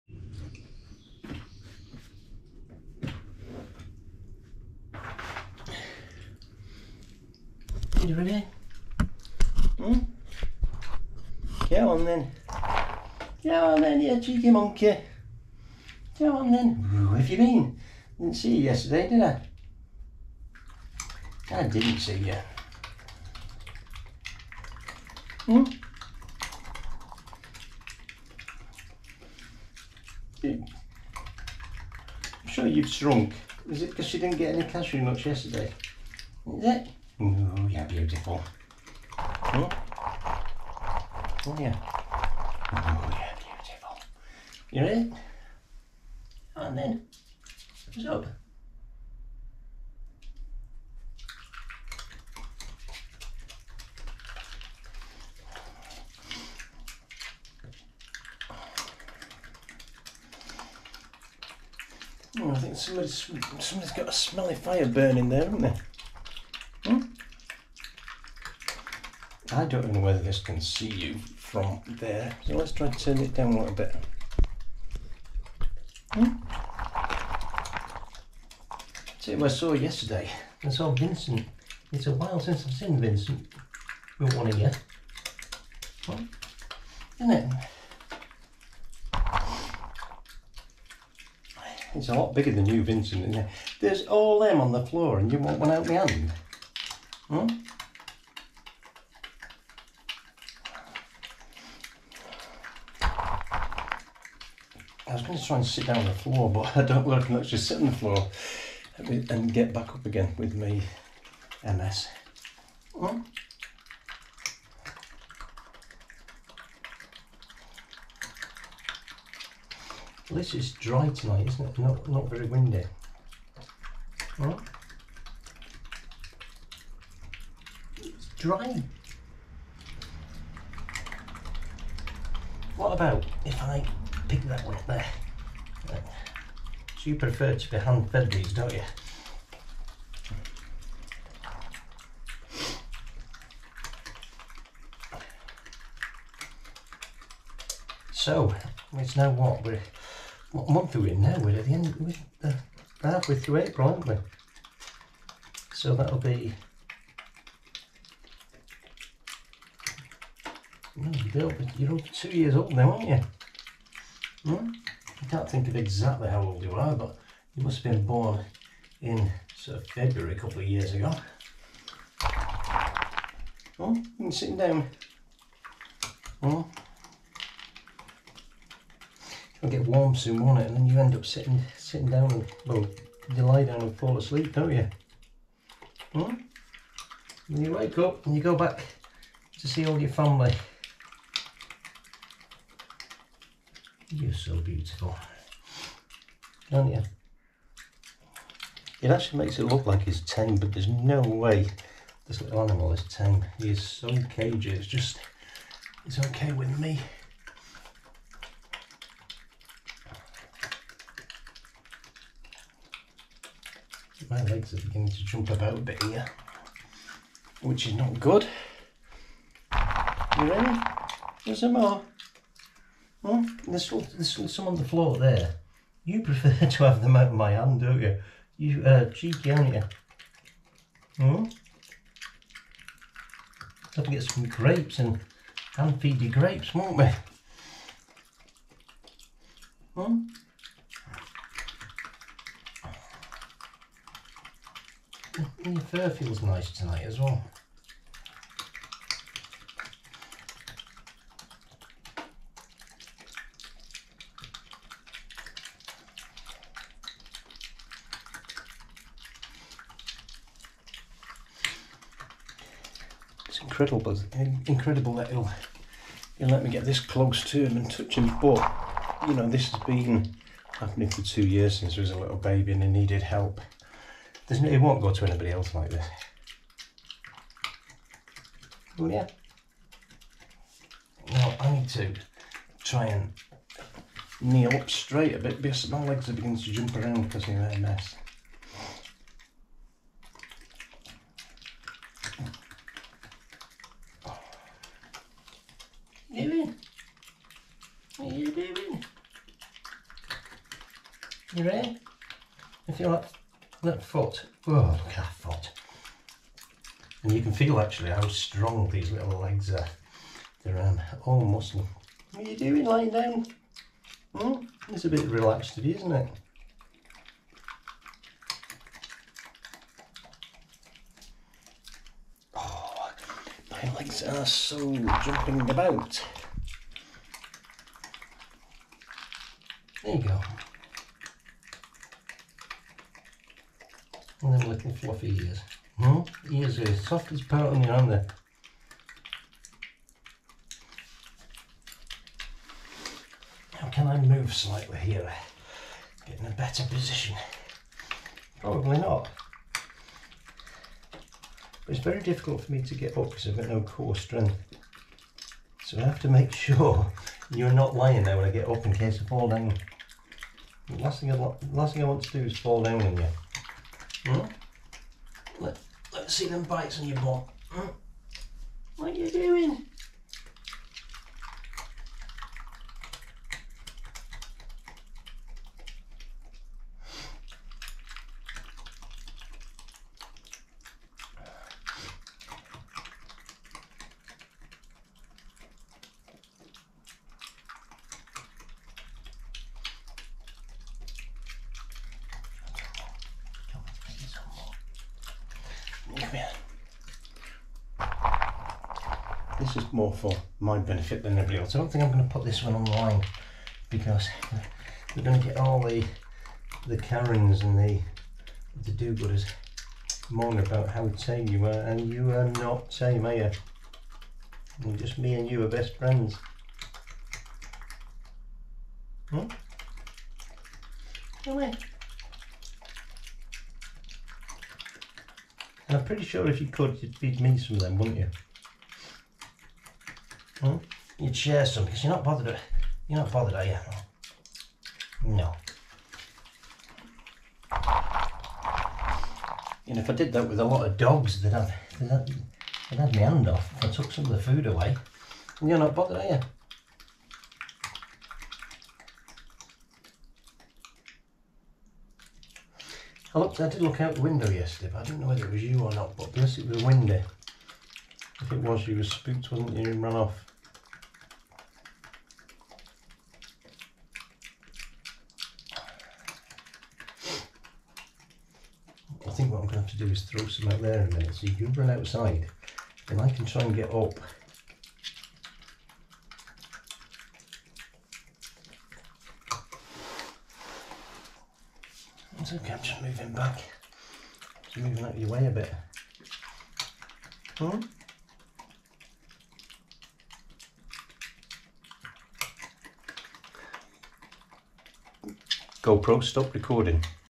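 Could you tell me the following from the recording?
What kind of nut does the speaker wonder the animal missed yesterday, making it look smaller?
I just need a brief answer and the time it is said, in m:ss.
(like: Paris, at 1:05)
cashew nuts, at 0:34.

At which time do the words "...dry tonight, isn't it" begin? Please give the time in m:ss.
2:00.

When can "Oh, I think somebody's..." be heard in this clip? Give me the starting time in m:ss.
1:02.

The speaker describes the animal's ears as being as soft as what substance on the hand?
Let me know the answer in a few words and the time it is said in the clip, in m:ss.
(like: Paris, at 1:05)
powder, at 5:37.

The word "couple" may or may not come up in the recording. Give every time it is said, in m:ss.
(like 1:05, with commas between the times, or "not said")
2:50.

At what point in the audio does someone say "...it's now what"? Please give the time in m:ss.
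2:28.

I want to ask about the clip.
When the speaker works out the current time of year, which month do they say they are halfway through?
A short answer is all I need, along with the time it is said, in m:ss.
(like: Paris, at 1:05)
April, at 2:33.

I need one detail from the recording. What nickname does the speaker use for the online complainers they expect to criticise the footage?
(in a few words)
Karens.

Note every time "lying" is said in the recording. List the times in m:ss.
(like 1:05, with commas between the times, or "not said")
5:12, 5:57.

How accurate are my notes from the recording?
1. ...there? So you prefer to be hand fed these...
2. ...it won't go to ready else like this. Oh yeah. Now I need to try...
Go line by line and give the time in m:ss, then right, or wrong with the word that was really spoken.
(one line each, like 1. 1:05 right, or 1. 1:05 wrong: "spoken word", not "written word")
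1. 2:14 right
2. 4:34 wrong: "anybody", not "ready".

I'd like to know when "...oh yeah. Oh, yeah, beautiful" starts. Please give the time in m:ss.
0:41.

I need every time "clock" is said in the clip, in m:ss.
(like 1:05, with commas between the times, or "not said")
not said.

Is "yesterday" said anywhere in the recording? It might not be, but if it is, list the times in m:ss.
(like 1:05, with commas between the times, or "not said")
0:18, 0:35, 1:19, 7:34.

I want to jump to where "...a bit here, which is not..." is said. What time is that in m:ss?
3:35.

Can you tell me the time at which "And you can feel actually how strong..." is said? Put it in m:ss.
5:07.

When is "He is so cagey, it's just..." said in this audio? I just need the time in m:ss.
3:23.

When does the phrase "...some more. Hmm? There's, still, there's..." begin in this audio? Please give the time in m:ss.
3:41.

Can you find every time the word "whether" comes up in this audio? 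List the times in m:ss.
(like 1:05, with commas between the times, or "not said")
1:09, 7:35.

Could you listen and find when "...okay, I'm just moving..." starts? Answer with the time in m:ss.
8:02.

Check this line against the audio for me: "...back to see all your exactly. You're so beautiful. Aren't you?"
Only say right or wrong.
wrong.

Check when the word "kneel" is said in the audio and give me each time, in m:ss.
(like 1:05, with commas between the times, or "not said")
4:44.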